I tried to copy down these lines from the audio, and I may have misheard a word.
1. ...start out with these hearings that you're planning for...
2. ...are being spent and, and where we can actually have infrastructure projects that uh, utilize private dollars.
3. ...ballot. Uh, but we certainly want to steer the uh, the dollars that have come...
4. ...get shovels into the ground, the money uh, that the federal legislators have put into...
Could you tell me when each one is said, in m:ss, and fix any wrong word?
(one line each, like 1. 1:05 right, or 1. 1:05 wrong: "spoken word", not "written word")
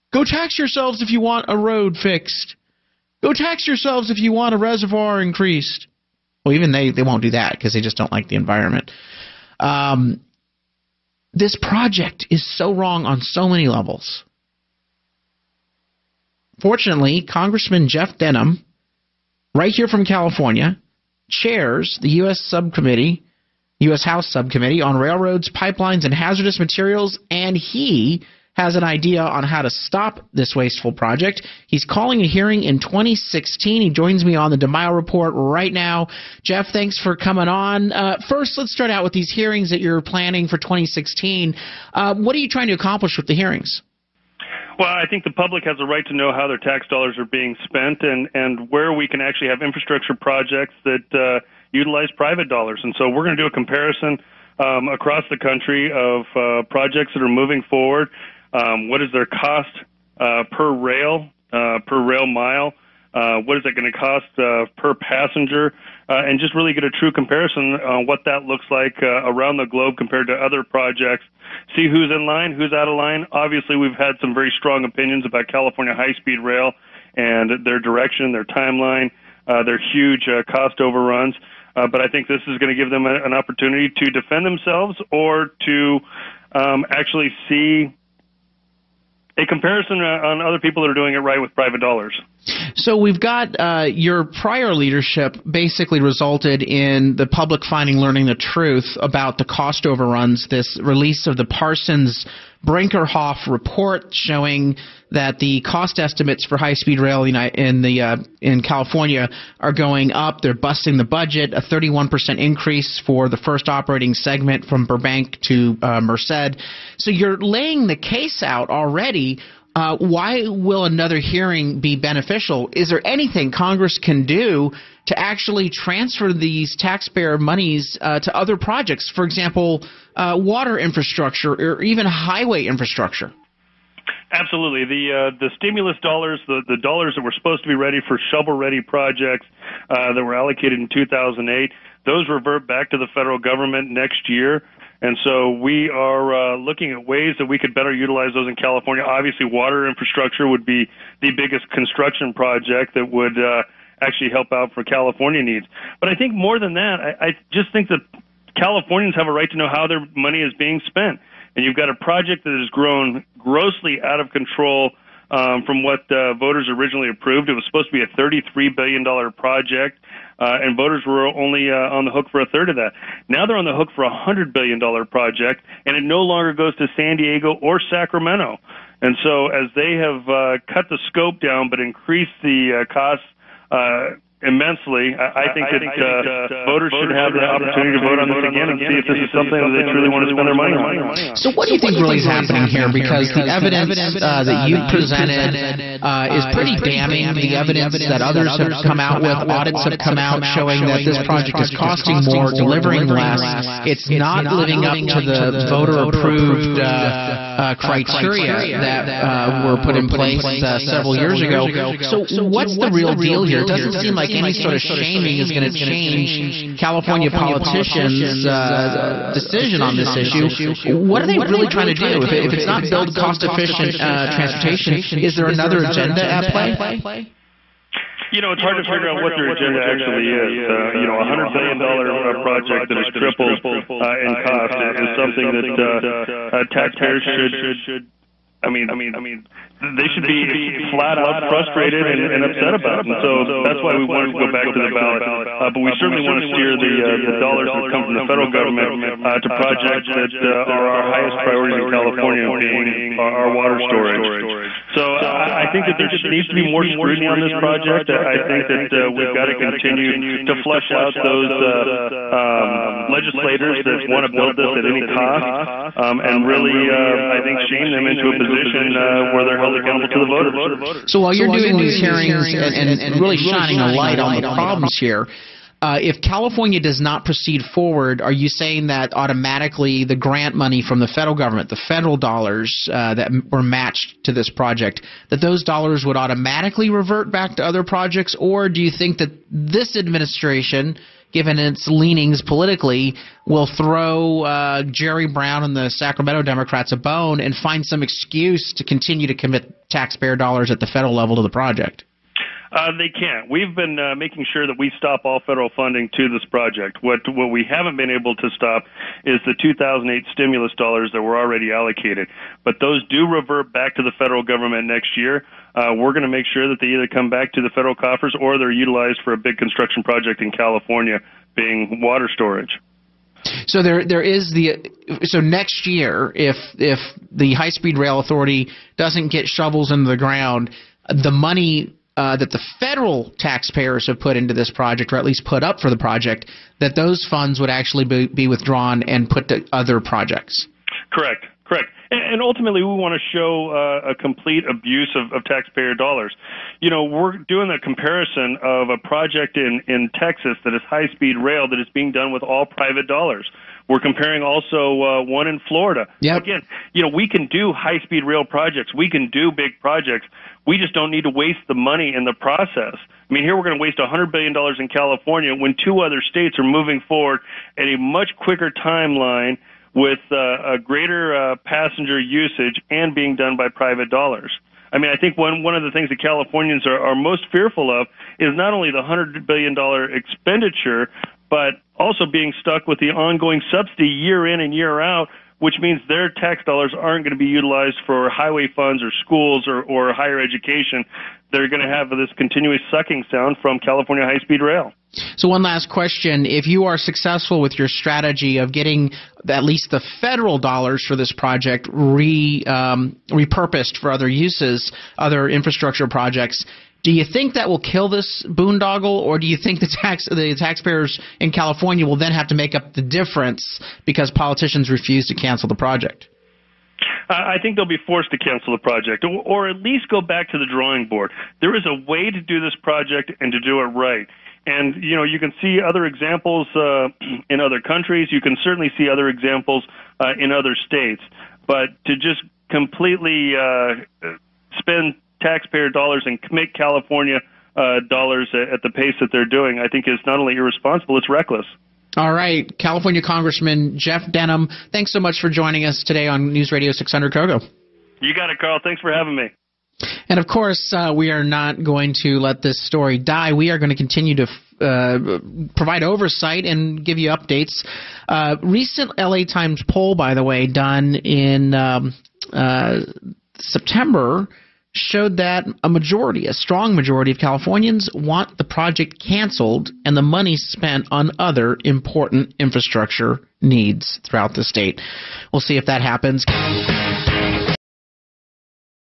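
1. 0:38 right
2. 0:47 right
3. 4:04 right
4. 5:29 wrong: "taxpayers", not "legislators".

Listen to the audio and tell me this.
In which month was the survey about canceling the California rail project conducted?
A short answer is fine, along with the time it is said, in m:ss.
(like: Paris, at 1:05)
September, at 7:43.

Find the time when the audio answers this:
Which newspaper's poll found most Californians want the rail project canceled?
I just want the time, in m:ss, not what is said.
7:39.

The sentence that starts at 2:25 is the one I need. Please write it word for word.
And so we are uh, looking at ways that we could better utilize those in California.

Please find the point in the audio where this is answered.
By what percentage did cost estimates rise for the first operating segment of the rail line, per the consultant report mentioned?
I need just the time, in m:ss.
1:51.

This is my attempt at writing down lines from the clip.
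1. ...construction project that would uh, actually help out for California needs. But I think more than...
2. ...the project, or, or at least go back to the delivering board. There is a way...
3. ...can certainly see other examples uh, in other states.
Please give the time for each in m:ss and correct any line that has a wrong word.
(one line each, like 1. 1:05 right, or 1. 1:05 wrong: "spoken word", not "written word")
1. 2:31 right
2. 6:58 wrong: "drawing", not "delivering"
3. 7:08 right.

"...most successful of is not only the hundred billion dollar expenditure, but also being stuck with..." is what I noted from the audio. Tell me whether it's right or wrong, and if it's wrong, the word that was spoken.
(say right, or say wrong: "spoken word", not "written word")
wrong: "fearful", not "successful".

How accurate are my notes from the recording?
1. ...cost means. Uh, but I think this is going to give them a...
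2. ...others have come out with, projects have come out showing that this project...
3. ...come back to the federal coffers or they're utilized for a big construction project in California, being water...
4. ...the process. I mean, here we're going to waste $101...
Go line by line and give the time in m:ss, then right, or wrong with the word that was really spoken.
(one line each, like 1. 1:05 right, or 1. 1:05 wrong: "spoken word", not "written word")
1. 1:20 wrong: "overruns", not "means"
2. 3:18 wrong: "audits", not "projects"
3. 5:17 right
4. 6:02 wrong: "100", not "101".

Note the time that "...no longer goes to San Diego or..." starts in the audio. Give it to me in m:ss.
2:56.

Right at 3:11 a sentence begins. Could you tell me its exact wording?
So, what do you think really is happening here?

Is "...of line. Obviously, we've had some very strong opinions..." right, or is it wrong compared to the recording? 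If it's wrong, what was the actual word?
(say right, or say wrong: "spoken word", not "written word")
right.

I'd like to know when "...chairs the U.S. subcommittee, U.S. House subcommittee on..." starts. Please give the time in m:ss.
0:21.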